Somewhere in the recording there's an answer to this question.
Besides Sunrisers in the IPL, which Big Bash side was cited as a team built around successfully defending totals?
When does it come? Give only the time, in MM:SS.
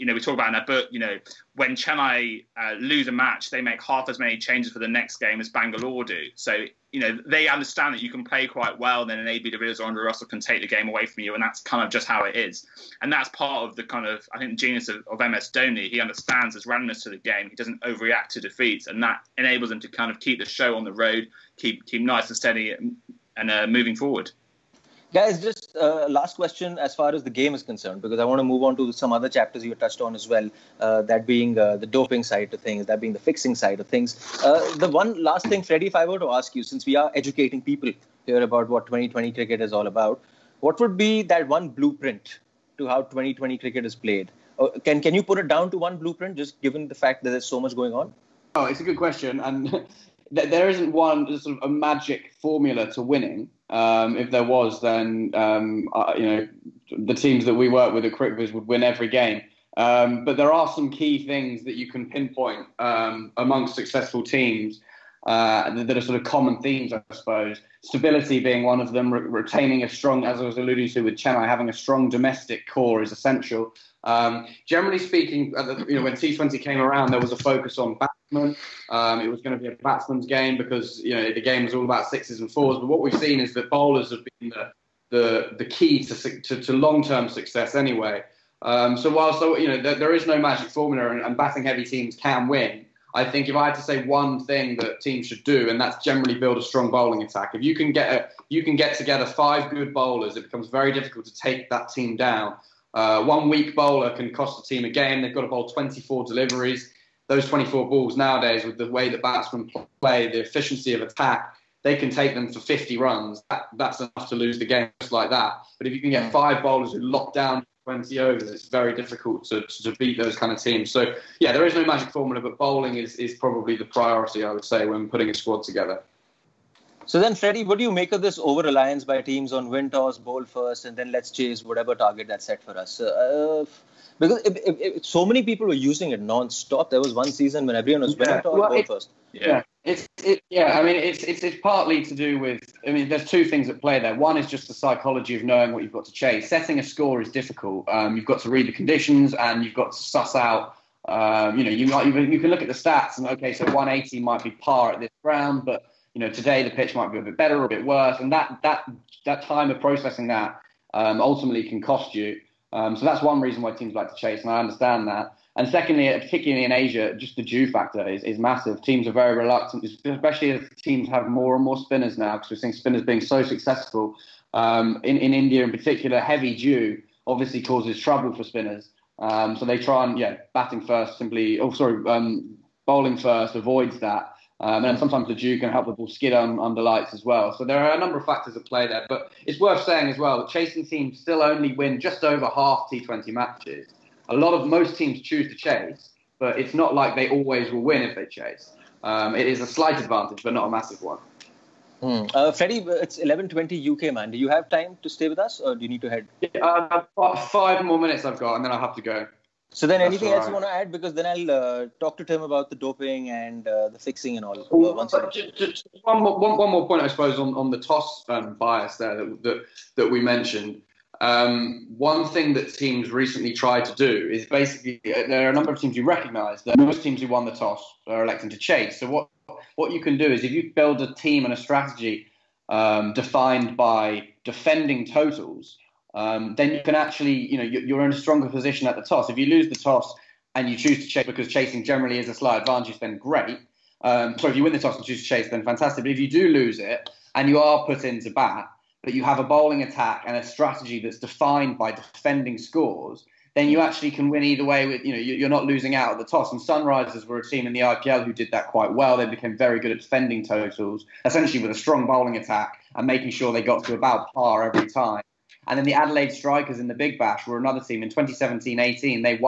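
04:25.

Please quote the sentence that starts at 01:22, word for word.
But what we've seen is that bowlers have been the the, the key to to, to long term success anyway.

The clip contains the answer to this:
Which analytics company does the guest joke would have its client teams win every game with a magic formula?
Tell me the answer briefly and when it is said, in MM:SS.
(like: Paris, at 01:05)
CrickViz, at 00:58.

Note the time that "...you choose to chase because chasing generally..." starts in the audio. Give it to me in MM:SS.
04:00.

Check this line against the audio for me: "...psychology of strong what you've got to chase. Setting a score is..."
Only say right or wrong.
wrong.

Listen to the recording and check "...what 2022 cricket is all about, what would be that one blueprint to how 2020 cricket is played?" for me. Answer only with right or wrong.
wrong.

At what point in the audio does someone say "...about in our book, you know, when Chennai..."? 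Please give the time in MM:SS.
00:00.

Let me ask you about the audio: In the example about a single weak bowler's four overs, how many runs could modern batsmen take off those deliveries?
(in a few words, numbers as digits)
50.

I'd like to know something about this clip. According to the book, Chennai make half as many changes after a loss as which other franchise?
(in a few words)
Bangalore.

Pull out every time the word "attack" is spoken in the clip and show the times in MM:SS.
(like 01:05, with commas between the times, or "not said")
01:37, 01:51, 04:09, 04:22.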